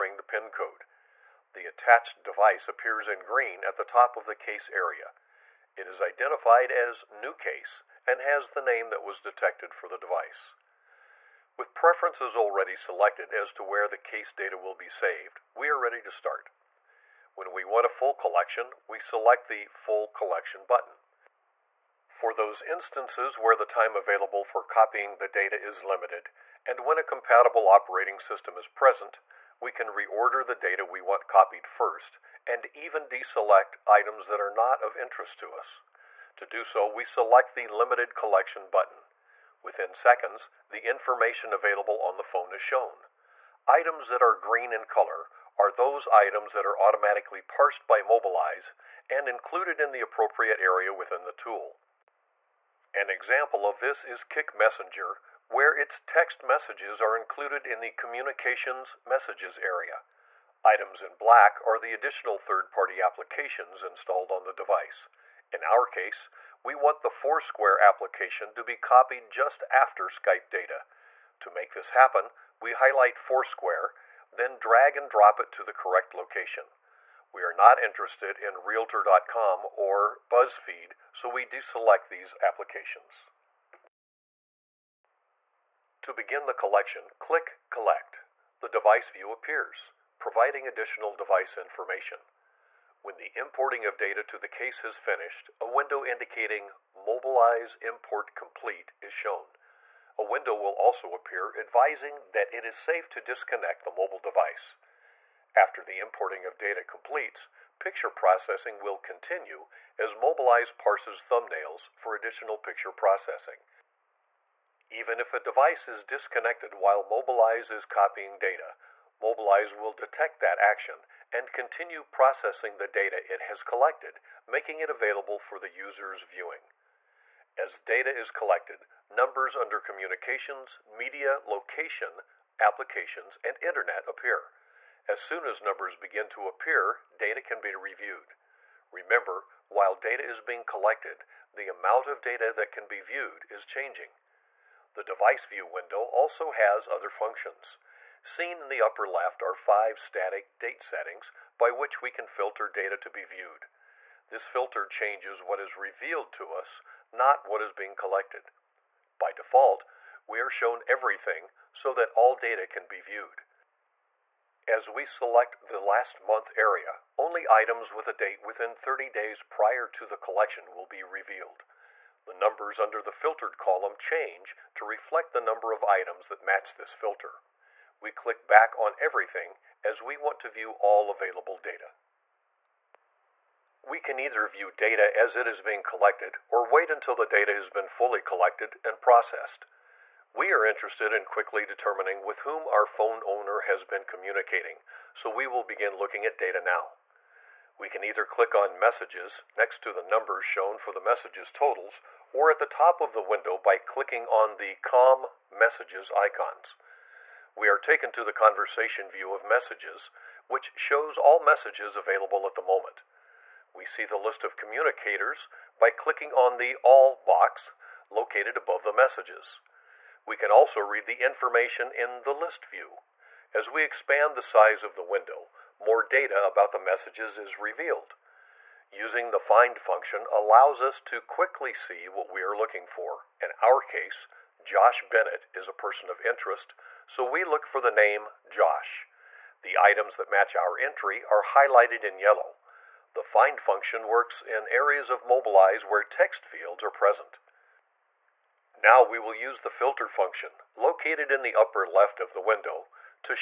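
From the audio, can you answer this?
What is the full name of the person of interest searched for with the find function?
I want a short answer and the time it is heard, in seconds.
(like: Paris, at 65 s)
Josh Bennett, at 234 s.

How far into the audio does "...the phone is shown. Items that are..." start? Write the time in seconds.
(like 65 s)
42 s.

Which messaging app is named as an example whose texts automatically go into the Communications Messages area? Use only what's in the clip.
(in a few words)
Kik Messenger.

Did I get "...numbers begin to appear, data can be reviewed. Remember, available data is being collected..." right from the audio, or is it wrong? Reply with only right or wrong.
wrong.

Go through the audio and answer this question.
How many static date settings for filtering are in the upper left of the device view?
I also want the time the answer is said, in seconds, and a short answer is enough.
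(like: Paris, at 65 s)
5, at 149 s.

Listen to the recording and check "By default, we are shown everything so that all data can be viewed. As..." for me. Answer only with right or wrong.
right.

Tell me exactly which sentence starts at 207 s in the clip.
We are taken to the conversation view of Messages, which shows all messages available at the moment.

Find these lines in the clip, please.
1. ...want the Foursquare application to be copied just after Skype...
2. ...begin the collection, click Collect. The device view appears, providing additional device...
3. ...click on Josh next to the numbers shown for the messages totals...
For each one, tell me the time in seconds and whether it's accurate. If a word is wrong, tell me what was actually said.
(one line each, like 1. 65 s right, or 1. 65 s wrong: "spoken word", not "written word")
1. 66 s right
2. 86 s right
3. 198 s wrong: "Messages", not "Josh".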